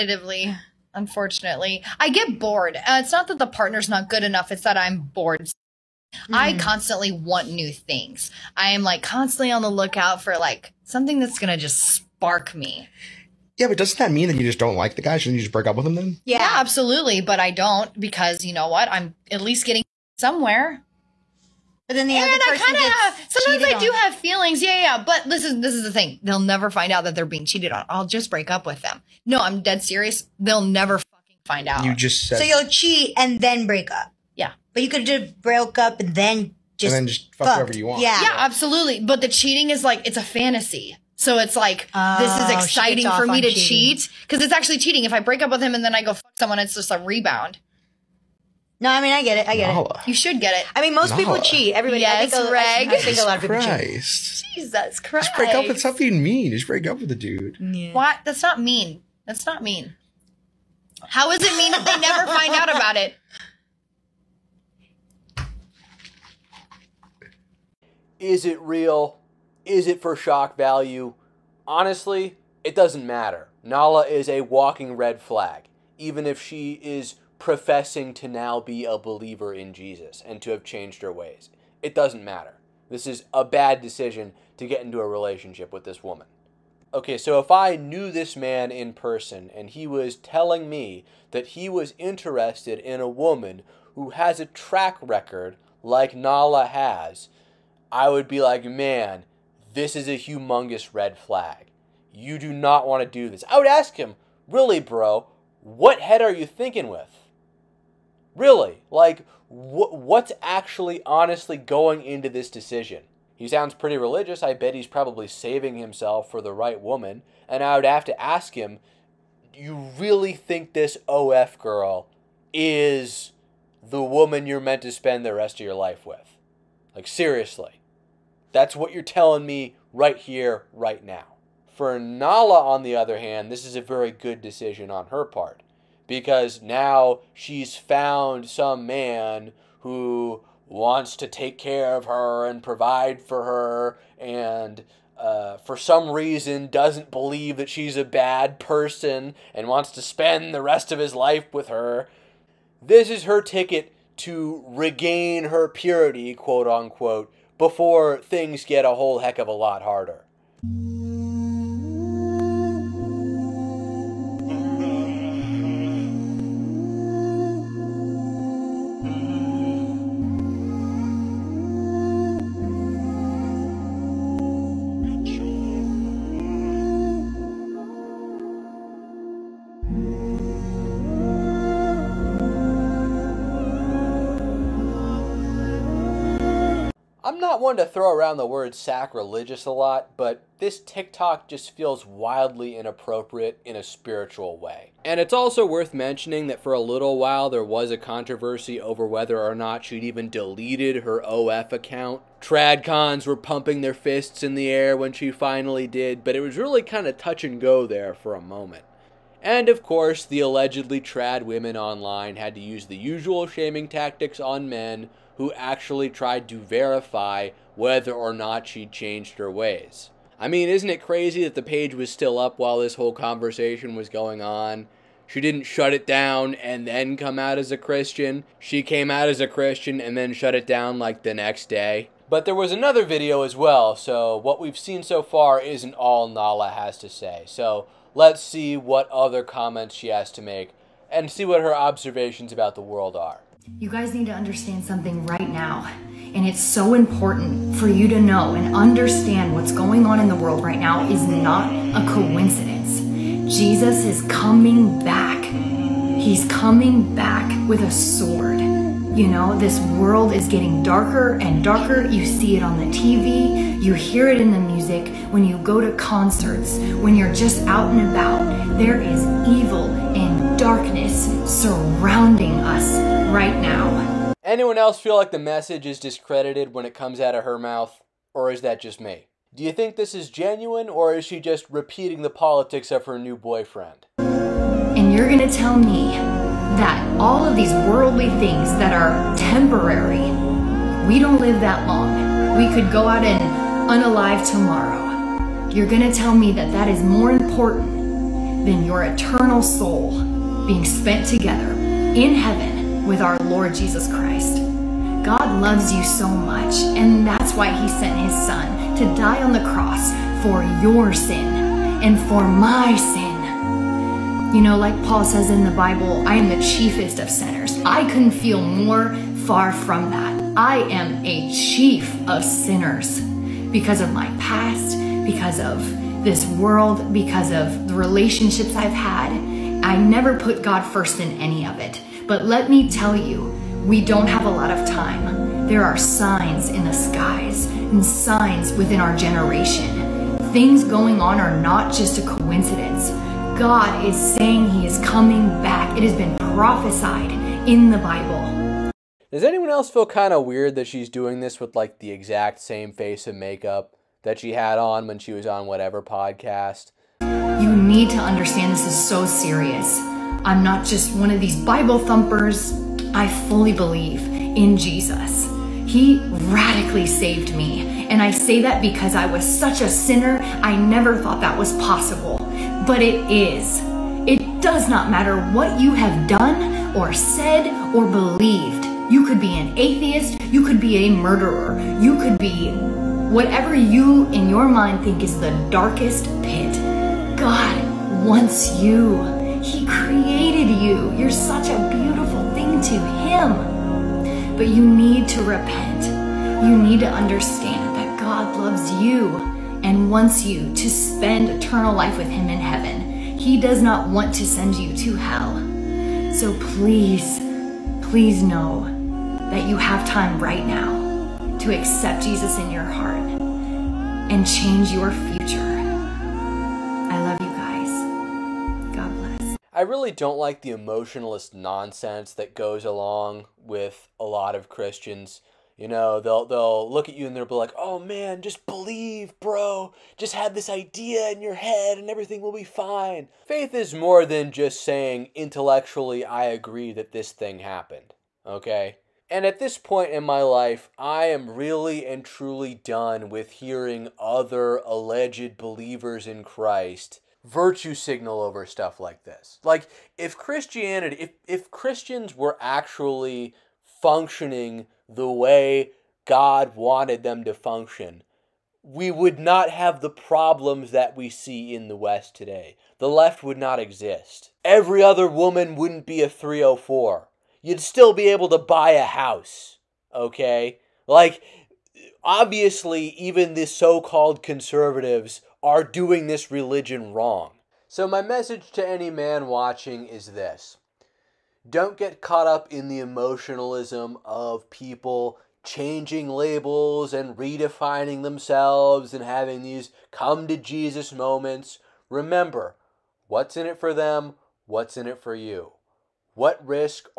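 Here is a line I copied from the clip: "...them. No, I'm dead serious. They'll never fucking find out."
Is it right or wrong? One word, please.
right.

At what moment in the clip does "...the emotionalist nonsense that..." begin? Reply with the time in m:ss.
7:00.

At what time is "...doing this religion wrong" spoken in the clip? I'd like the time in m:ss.
7:55.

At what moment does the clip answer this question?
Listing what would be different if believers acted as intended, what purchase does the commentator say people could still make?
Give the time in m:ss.
7:48.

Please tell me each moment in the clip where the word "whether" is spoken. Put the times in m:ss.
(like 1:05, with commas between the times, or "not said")
3:19, 3:37.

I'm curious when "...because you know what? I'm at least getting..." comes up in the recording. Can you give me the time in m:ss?
0:17.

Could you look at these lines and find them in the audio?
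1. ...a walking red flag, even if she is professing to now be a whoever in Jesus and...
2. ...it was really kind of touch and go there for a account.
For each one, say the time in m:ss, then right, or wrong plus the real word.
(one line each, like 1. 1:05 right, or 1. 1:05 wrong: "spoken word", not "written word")
1. 1:14 wrong: "believer", not "whoever"
2. 3:26 wrong: "moment", not "account".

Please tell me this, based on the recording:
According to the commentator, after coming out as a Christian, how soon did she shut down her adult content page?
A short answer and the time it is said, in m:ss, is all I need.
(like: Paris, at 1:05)
the next day, at 3:50.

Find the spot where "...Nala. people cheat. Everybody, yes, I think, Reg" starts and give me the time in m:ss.
0:51.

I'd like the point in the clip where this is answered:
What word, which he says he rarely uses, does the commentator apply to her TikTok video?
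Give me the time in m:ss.
3:08.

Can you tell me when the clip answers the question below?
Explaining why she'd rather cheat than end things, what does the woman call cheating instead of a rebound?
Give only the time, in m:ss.
0:40.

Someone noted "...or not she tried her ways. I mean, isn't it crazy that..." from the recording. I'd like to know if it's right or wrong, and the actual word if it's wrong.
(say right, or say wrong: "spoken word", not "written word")
wrong: "changed", not "tried".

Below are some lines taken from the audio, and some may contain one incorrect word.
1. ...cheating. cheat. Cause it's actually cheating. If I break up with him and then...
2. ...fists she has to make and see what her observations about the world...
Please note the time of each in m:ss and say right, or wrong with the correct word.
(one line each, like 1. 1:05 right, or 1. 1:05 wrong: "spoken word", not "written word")
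1. 0:43 right
2. 3:59 wrong: "comments", not "fists".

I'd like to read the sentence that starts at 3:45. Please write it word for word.
She didn't shut it down and then come out as a Christian.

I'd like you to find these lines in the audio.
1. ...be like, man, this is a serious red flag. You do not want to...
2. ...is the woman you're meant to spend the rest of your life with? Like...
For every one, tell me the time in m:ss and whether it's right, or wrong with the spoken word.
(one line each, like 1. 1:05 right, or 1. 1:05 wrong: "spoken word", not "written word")
1. 1:38 wrong: "humongous", not "serious"
2. 2:02 right.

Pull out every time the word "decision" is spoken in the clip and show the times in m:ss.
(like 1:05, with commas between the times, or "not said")
1:23, 1:52, 2:14.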